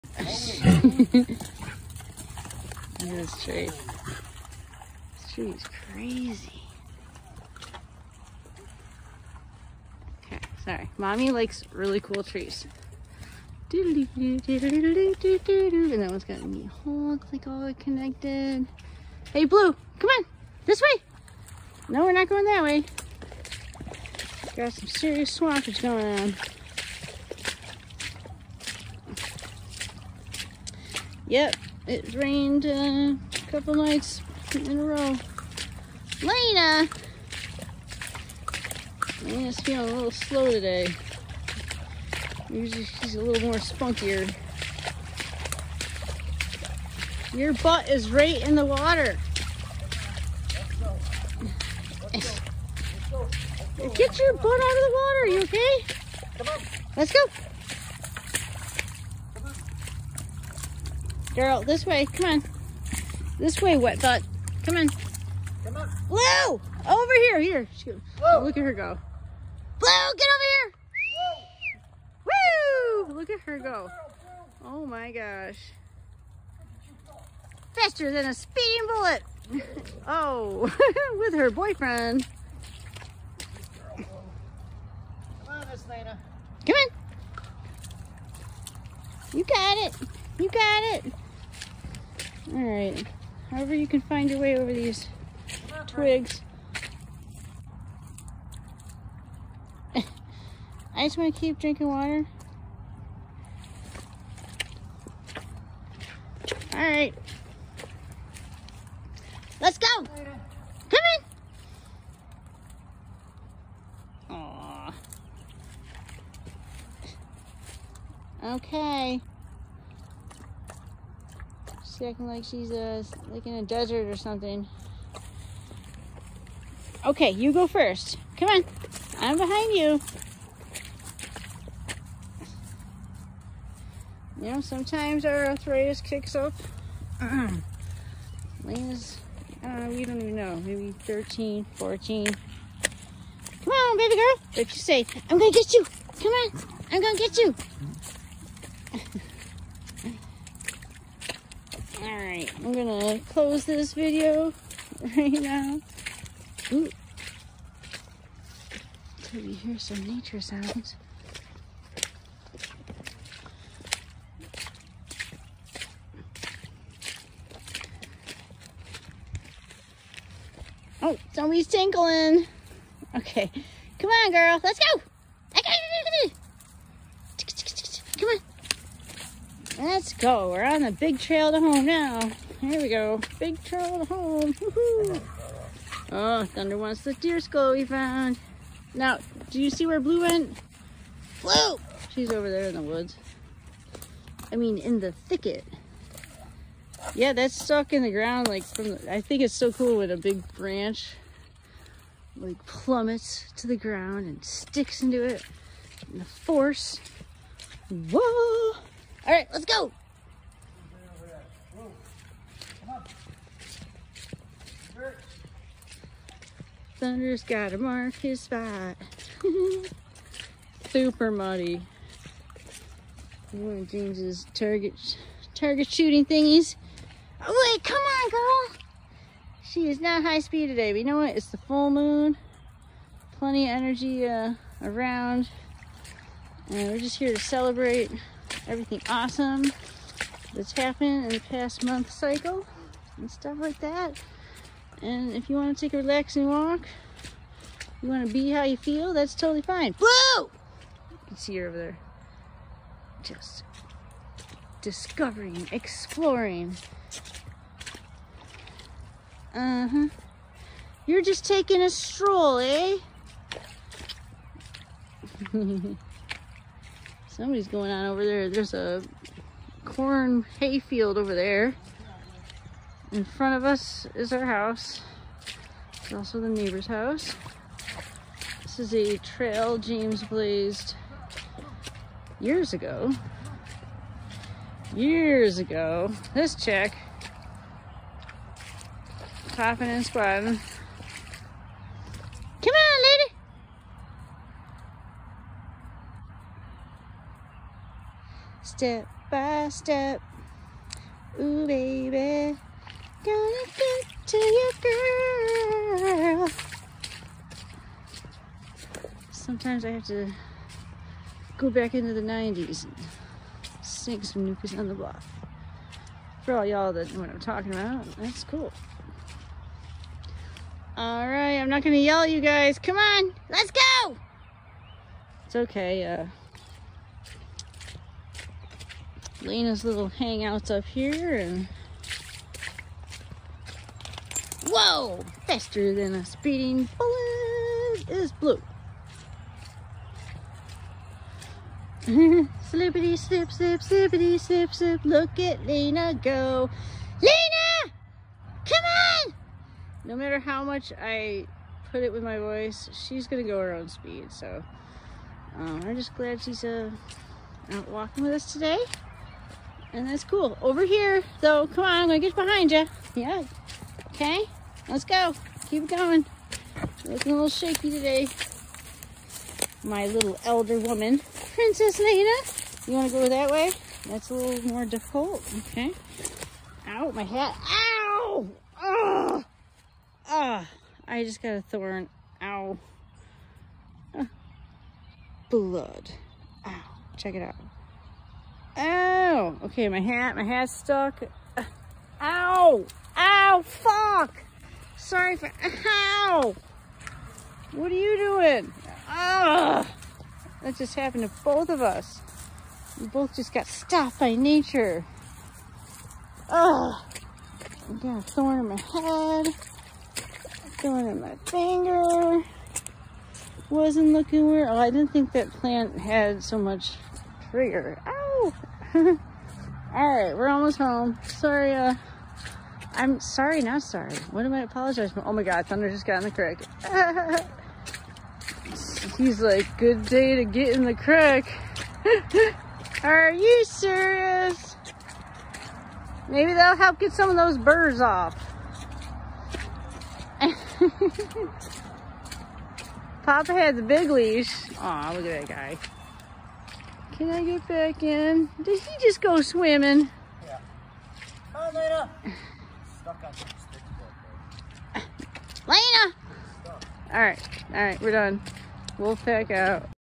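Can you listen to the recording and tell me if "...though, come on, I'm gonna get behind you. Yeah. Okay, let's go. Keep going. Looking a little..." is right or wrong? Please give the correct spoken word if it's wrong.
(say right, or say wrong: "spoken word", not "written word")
right.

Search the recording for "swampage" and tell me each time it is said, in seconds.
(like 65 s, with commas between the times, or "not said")
25 s.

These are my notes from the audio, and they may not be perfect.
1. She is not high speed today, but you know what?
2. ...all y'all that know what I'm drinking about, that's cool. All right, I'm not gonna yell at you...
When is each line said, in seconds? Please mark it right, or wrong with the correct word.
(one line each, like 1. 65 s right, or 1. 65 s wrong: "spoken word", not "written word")
1. 229 s right
2. 316 s wrong: "talking", not "drinking".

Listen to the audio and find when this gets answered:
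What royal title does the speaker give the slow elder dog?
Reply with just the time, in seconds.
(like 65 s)
371 s.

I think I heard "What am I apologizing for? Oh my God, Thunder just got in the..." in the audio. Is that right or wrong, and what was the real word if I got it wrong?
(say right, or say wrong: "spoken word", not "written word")
right.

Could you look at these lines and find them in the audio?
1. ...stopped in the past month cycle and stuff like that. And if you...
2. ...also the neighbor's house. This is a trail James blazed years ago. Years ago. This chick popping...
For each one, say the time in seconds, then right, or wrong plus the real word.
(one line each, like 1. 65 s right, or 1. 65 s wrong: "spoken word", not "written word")
1. 240 s wrong: "happened", not "stopped"
2. 276 s right.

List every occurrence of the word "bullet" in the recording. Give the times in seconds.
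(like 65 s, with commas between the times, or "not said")
78 s, 336 s.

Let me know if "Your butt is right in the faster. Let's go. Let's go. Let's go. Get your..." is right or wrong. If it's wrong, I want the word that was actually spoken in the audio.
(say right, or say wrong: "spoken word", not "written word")
wrong: "water", not "faster".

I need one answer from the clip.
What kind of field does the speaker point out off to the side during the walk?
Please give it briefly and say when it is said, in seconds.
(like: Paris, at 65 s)
Corn hay field, at 269 s.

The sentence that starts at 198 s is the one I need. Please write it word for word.
Like, from the, I think it's so cool when a big branch like plummets to the ground and sticks into it.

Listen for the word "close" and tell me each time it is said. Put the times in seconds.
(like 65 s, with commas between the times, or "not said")
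153 s.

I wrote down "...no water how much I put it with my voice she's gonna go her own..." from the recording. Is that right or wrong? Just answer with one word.
wrong.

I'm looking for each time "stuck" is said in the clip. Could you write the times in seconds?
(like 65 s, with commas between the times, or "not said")
197 s, 390 s, 453 s.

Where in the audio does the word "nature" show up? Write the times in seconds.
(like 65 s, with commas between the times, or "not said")
160 s, 404 s.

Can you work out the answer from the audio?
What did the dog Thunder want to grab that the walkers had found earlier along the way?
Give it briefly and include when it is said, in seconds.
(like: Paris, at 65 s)
The deer skull, at 187 s.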